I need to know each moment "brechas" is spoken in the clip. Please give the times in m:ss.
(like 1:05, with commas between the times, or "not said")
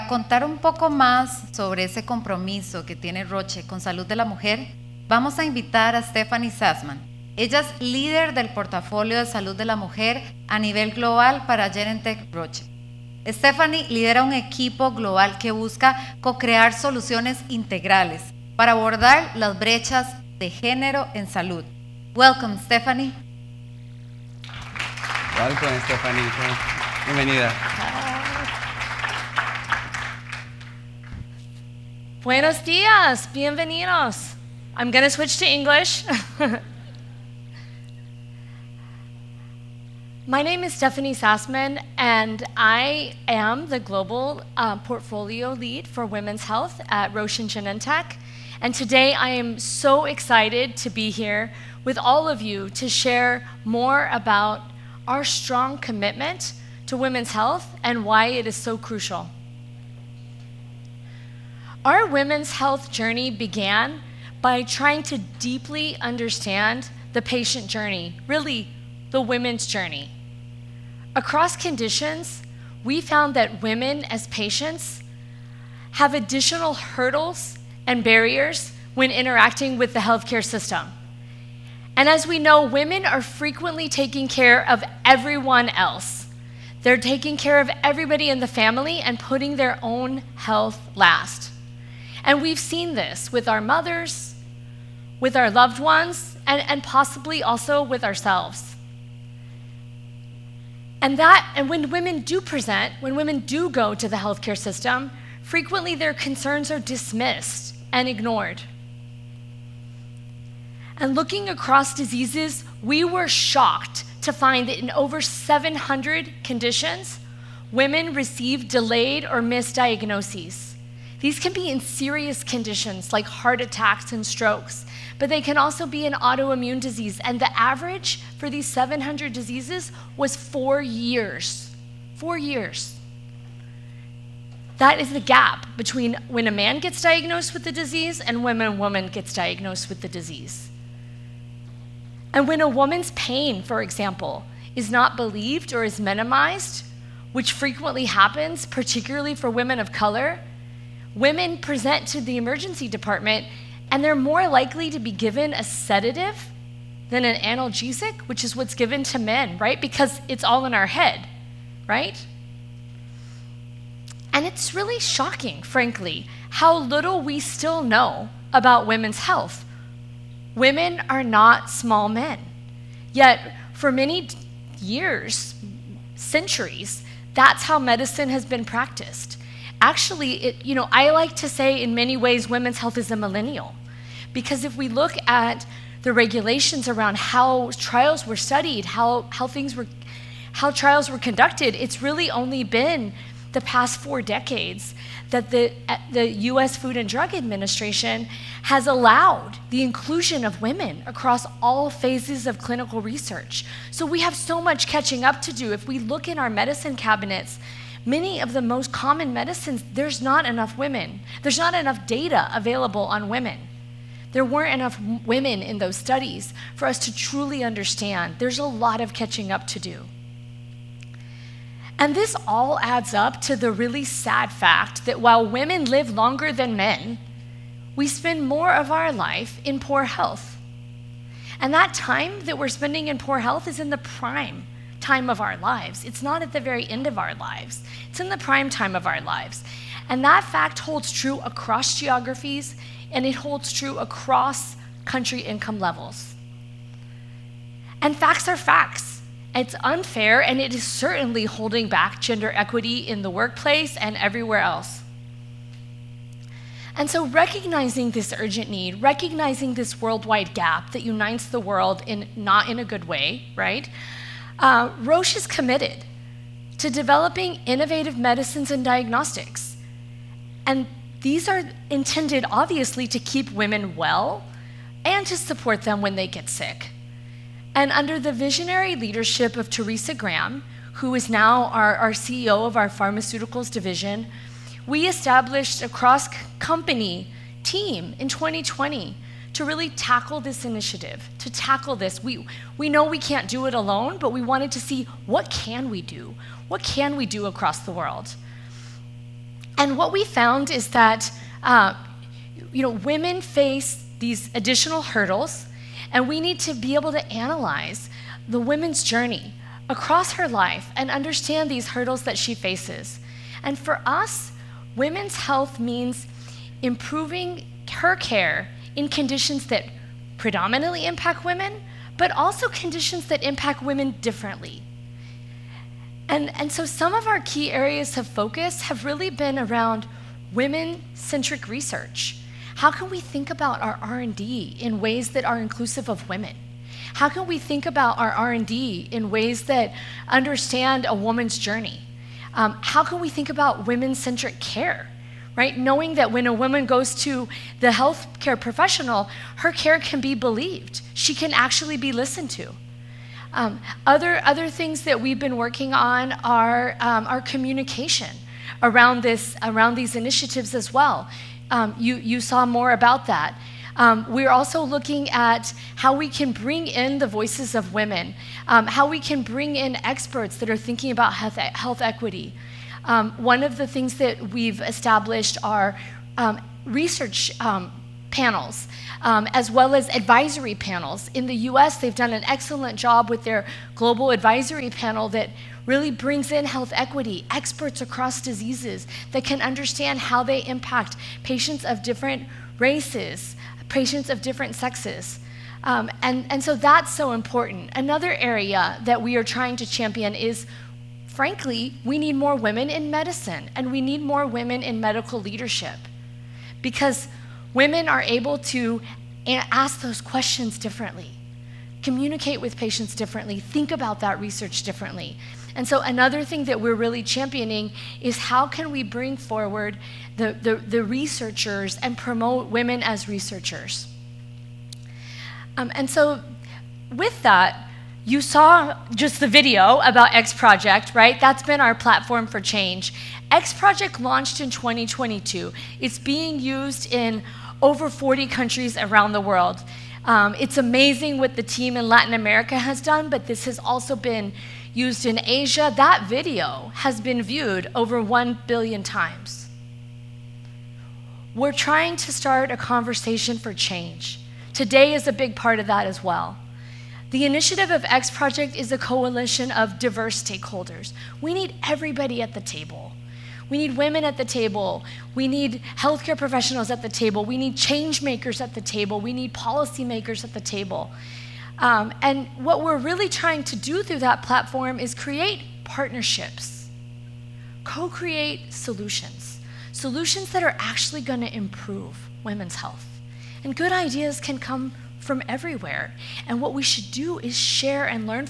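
0:19.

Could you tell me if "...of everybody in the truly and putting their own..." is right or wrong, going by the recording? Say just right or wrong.
wrong.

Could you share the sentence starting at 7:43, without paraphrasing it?
We need women at the table.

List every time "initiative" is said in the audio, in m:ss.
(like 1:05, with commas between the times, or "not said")
4:50, 6:00, 7:37.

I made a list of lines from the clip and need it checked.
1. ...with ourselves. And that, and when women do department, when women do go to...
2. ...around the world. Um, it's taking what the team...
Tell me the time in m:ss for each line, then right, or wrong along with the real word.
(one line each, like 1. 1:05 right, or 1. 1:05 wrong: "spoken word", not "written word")
1. 1:37 wrong: "present", not "department"
2. 7:18 wrong: "amazing", not "taking".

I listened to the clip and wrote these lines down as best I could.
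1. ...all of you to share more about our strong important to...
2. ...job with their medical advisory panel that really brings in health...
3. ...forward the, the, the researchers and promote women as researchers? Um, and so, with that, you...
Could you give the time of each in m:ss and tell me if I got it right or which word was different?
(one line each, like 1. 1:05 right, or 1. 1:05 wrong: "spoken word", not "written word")
1. 0:51 wrong: "commitment", not "important"
2. 6:22 wrong: "global", not "medical"
3. 6:59 right.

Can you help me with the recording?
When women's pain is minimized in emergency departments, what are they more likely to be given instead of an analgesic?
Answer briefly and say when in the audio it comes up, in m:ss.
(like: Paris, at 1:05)
A sedative, at 2:35.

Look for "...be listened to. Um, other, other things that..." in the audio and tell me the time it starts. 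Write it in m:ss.
5:51.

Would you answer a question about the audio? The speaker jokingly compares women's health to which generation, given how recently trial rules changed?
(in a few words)
A millennial.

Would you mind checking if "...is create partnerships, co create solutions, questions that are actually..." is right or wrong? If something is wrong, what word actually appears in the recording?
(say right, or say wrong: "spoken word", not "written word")
wrong: "solutions", not "questions".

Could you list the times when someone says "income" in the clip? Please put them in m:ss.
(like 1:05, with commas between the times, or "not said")
4:05.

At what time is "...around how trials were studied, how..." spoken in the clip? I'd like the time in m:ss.
3:06.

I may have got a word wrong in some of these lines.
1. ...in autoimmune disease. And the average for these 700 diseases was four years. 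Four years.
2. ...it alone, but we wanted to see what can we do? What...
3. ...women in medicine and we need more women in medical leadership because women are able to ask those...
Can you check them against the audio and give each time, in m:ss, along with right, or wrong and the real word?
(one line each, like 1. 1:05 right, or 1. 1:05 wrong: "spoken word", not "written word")
1. 2:06 right
2. 4:53 right
3. 6:42 right.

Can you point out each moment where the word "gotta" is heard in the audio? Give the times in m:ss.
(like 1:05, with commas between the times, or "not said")
not said.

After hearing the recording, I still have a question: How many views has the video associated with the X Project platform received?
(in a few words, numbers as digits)
Over 1 billion.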